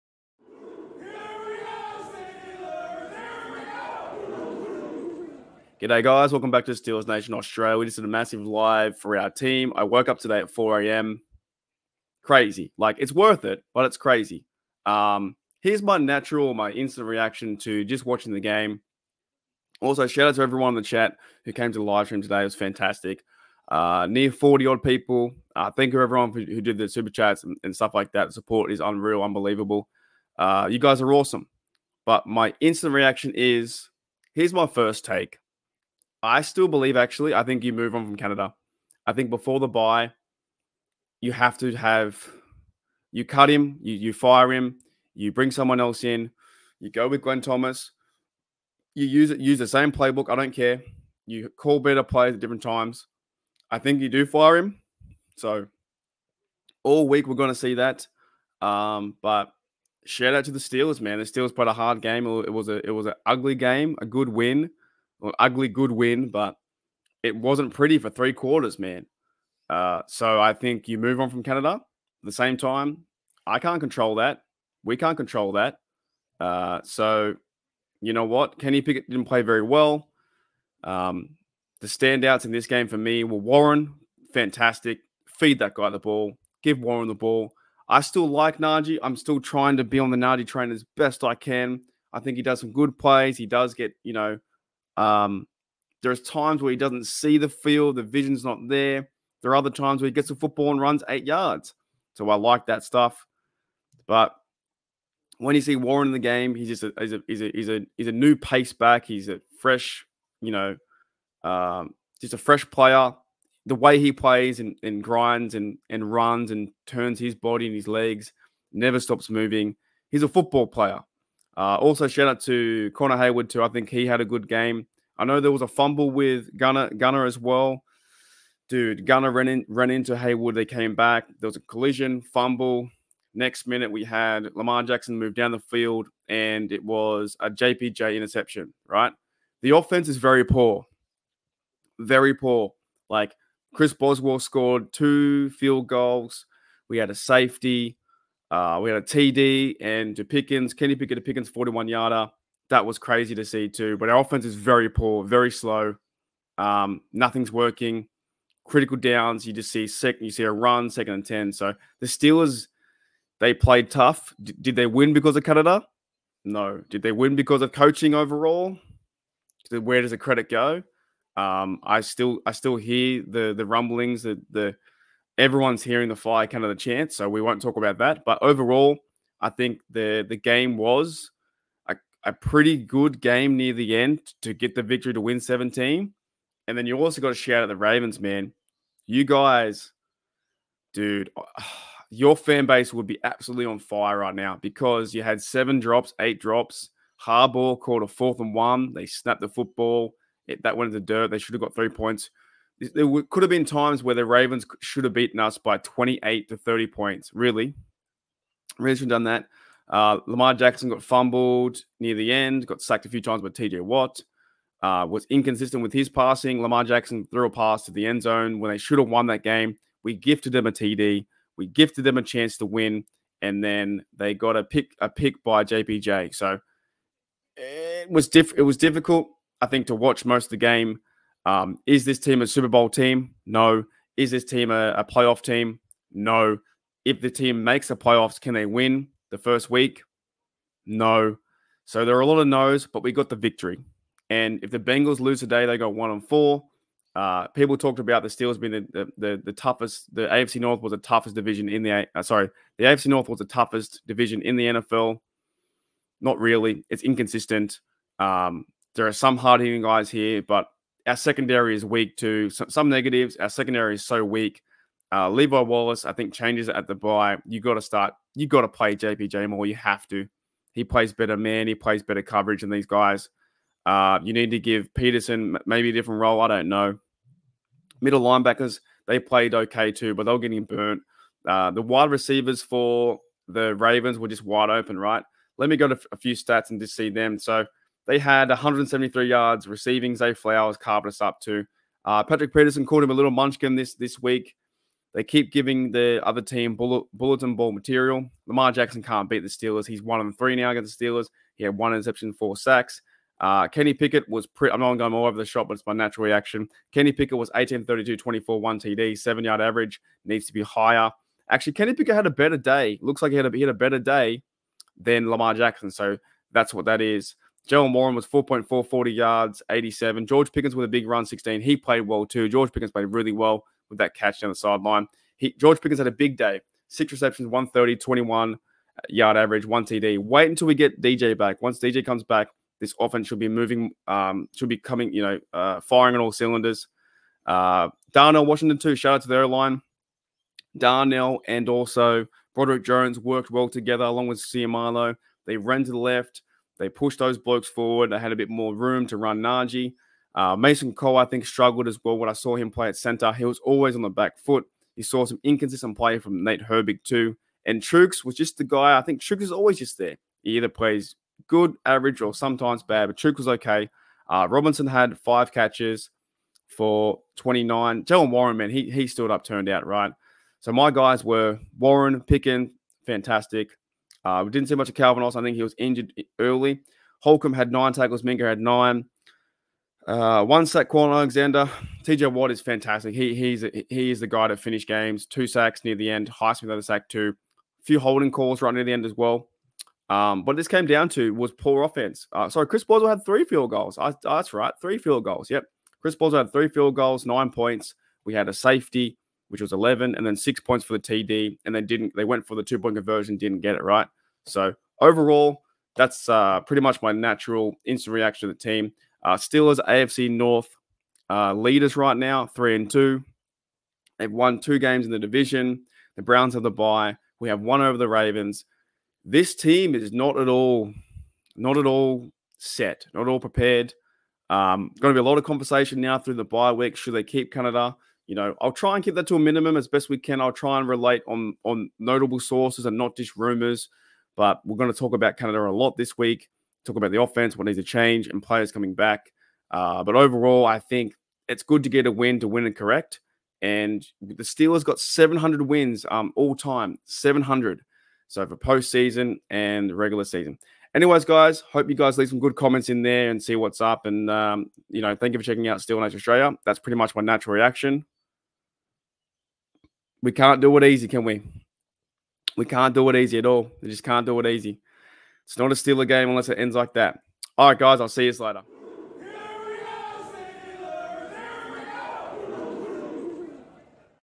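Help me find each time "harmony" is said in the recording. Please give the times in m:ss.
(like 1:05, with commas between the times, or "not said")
not said.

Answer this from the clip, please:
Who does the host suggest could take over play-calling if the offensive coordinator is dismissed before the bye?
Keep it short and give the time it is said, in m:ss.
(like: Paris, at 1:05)
Glenn Thomas, at 0:47.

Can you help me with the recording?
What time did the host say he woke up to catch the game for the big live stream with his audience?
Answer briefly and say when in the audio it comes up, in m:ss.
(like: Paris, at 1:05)
4 a.m., at 0:10.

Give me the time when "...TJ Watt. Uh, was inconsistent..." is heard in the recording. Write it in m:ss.
3:33.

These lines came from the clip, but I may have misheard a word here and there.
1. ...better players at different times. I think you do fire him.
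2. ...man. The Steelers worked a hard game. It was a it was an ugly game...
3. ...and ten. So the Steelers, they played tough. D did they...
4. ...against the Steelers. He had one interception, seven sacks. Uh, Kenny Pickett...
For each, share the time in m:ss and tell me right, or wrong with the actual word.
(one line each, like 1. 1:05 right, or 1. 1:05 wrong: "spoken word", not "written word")
1. 0:51 right
2. 1:01 wrong: "played", not "worked"
3. 2:41 right
4. 5:00 wrong: "four", not "seven".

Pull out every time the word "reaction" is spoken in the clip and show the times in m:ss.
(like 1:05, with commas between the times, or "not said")
0:17, 0:32, 5:06, 6:48, 7:37.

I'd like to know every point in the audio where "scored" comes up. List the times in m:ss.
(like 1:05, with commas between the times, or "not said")
2:24.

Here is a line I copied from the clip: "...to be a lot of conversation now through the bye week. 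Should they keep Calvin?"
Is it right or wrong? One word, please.
wrong.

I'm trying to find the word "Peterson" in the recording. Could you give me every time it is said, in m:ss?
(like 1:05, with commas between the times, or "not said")
4:34, 4:52.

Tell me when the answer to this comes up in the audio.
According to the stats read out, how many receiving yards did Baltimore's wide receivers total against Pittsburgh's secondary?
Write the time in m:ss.
4:48.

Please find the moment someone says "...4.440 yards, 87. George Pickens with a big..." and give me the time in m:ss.
5:18.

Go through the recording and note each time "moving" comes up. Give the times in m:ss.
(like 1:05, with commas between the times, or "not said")
1:59, 5:33.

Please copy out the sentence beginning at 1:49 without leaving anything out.
He's a fresh, you know, um, just a fresh player.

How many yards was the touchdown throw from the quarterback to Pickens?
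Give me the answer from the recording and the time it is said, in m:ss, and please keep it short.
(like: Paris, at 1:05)
41 yards, at 2:31.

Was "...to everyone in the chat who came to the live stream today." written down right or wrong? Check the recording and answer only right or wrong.
right.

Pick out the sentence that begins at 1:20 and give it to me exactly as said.
Um, the standouts in this game for me were Warren, fantastic.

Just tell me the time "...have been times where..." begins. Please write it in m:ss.
3:23.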